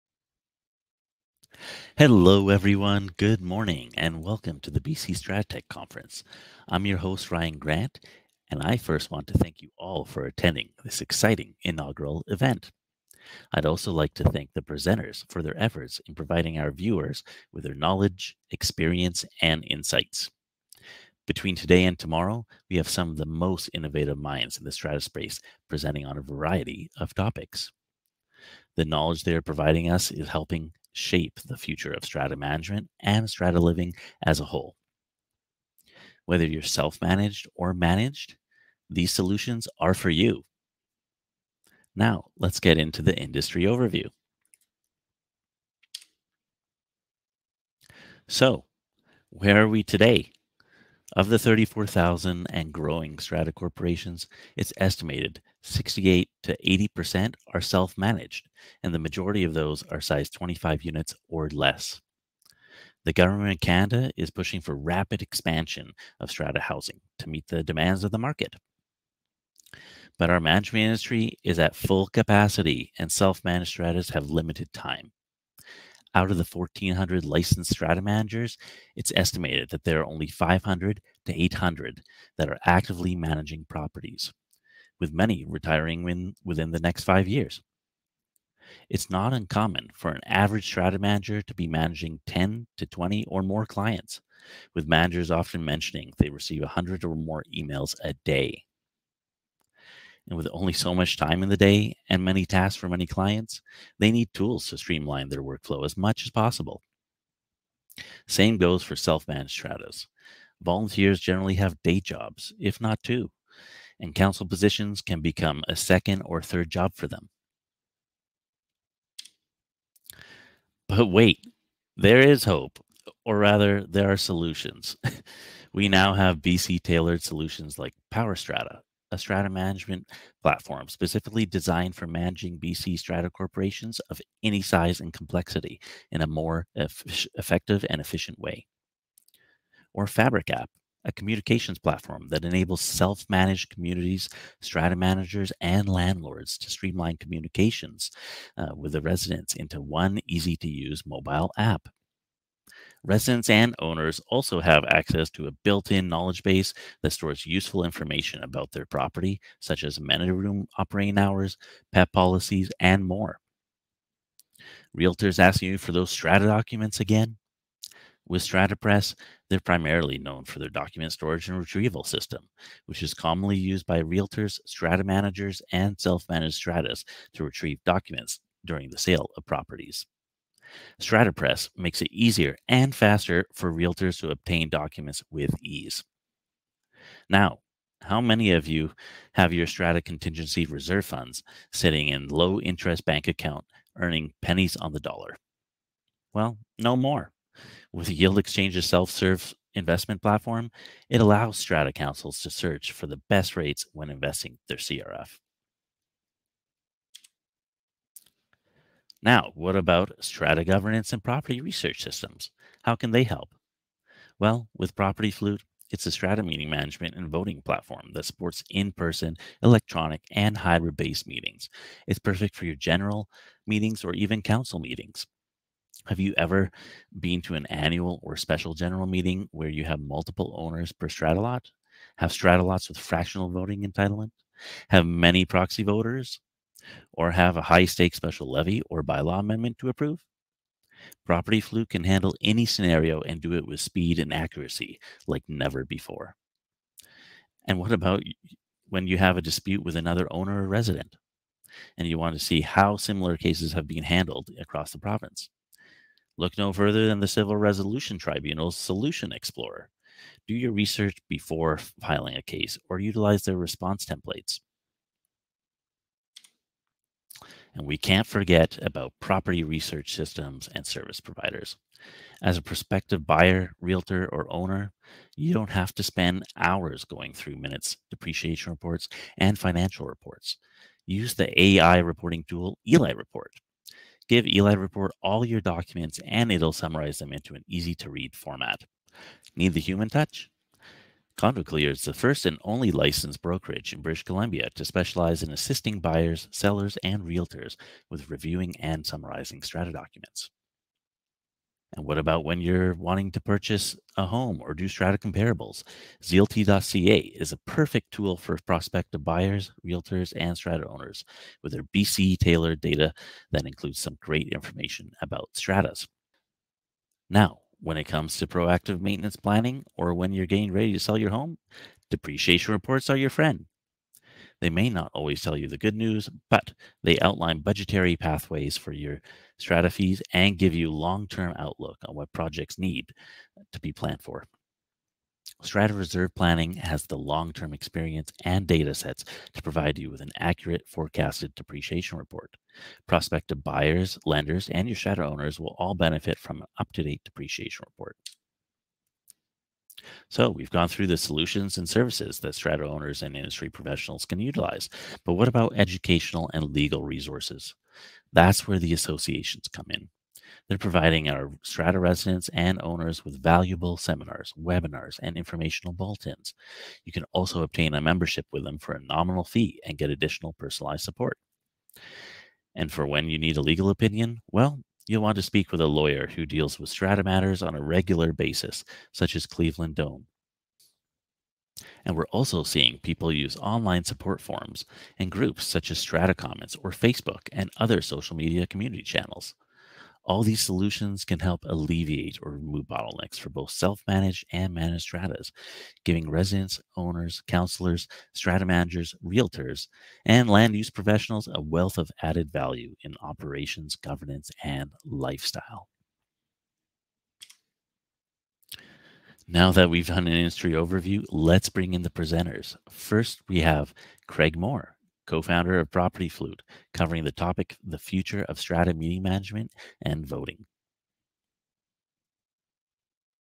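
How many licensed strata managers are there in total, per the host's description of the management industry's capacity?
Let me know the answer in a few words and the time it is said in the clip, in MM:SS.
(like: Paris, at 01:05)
1,400, at 01:16.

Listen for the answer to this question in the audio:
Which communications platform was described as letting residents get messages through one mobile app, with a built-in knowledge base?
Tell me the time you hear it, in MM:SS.
02:20.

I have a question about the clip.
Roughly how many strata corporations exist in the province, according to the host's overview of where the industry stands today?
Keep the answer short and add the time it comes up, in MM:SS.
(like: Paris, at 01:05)
34,000, at 00:51.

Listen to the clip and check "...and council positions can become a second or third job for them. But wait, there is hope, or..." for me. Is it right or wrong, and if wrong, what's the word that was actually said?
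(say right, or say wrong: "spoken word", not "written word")
right.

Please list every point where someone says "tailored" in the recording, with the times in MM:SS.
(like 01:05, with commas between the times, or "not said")
02:06, 05:12.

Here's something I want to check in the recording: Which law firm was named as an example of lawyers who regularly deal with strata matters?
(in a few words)
Cleveland Doan.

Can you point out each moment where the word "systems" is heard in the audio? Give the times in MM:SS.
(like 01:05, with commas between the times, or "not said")
02:52, 03:32, 04:30.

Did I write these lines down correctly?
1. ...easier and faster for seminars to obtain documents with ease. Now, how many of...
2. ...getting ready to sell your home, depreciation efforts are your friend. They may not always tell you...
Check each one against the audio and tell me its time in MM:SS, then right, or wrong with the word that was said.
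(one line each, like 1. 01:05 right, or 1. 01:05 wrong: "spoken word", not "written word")
1. 03:02 wrong: "realtors", not "seminars"
2. 05:20 wrong: "reports", not "efforts".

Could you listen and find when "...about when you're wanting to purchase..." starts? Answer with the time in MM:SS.
05:02.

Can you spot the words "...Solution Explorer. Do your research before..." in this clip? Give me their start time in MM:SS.
04:18.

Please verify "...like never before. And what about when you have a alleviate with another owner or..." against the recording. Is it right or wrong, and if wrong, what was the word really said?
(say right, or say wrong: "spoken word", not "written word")
wrong: "dispute", not "alleviate".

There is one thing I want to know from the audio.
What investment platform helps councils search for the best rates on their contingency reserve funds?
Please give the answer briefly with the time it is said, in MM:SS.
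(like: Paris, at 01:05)
Yield Exchange, at 03:18.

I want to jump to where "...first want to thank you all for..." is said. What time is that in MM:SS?
00:08.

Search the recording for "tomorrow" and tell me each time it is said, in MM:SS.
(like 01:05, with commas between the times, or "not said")
00:21.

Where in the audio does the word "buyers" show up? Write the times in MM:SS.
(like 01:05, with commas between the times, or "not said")
04:33, 04:55, 05:09, 05:43.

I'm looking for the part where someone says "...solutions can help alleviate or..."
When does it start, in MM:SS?
06:30.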